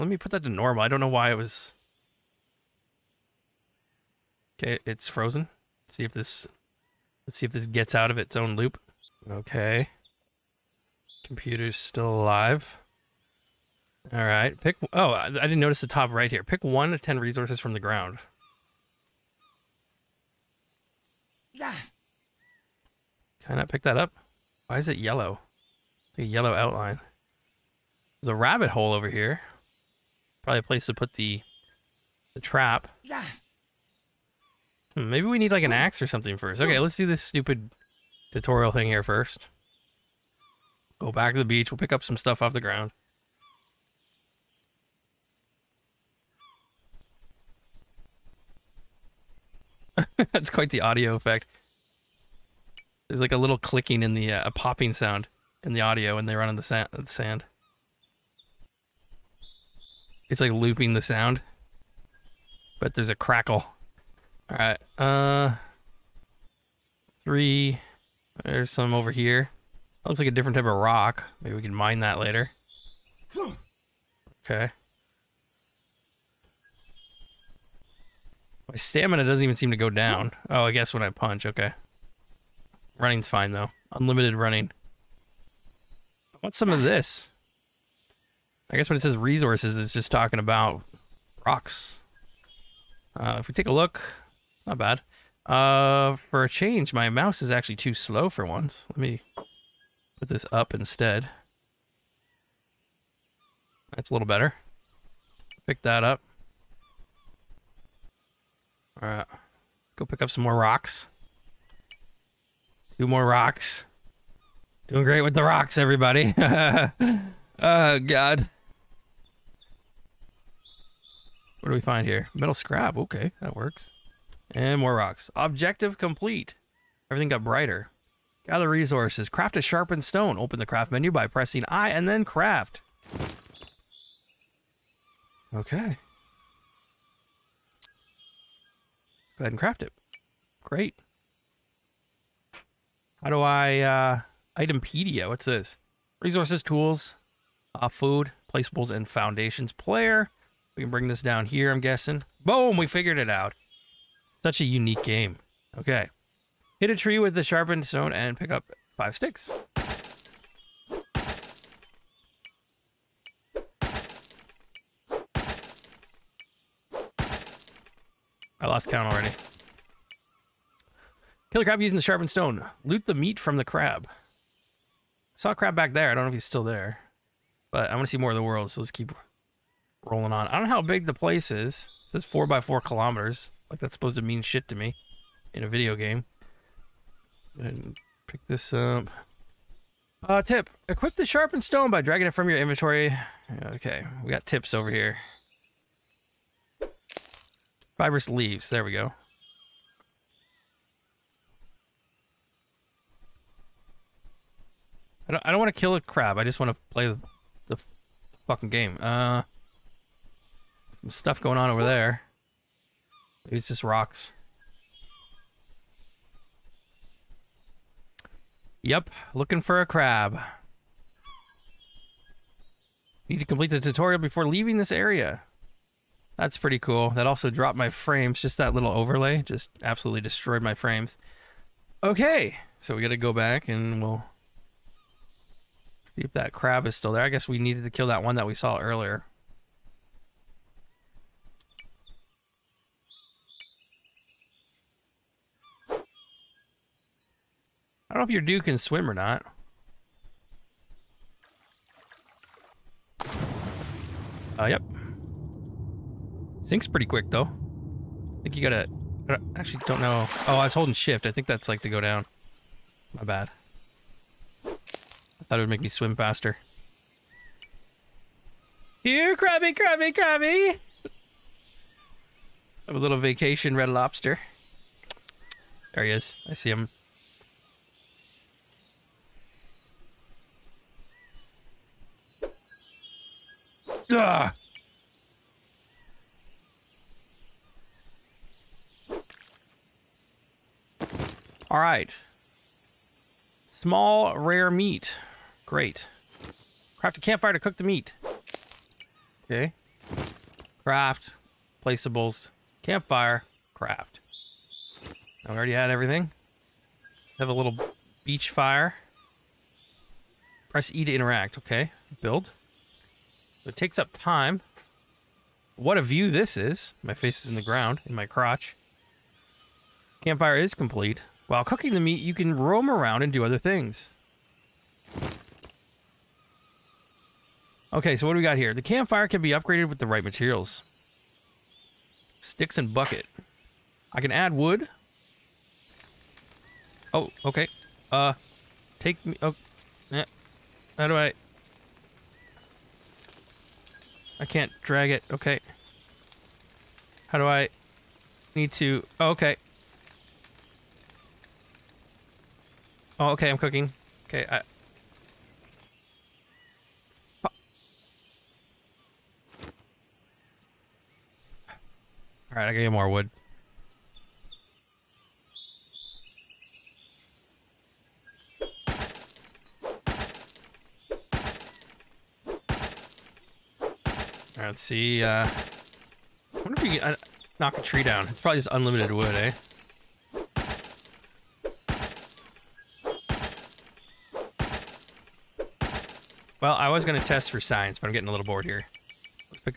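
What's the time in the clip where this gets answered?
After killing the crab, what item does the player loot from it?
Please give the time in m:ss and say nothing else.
4:53.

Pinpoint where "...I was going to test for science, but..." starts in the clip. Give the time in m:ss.
6:26.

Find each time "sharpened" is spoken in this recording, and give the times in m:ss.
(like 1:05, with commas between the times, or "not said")
2:09, 2:37, 2:52, 3:11.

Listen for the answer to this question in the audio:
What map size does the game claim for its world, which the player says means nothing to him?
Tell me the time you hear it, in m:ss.
3:02.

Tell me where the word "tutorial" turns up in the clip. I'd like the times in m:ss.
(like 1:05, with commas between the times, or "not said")
0:38, 3:43.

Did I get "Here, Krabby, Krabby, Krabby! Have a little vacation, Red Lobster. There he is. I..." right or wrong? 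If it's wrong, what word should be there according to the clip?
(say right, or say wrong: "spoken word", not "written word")
right.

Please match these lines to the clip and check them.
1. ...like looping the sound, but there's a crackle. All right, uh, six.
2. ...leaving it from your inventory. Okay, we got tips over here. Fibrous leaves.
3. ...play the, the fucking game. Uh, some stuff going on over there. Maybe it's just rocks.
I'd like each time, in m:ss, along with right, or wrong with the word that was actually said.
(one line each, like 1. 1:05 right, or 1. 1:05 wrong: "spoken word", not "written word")
1. 1:00 wrong: "three", not "six"
2. 3:12 wrong: "dragging", not "leaving"
3. 3:26 right.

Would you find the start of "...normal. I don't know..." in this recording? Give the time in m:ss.
0:00.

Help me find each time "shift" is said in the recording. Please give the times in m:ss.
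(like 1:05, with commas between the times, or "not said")
4:20.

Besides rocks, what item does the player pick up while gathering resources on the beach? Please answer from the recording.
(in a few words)
Metal scrap.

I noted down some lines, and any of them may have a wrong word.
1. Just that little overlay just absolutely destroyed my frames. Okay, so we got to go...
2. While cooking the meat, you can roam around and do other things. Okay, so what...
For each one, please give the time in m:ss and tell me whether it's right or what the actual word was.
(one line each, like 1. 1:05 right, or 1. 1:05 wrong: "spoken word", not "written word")
1. 3:48 right
2. 5:21 right.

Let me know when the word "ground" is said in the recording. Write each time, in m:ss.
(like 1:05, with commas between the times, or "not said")
0:17, 0:42, 5:17.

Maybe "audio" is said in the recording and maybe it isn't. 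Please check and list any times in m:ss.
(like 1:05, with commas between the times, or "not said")
0:50, 0:55.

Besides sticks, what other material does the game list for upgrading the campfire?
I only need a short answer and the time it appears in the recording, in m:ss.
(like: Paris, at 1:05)
Bucket, at 5:32.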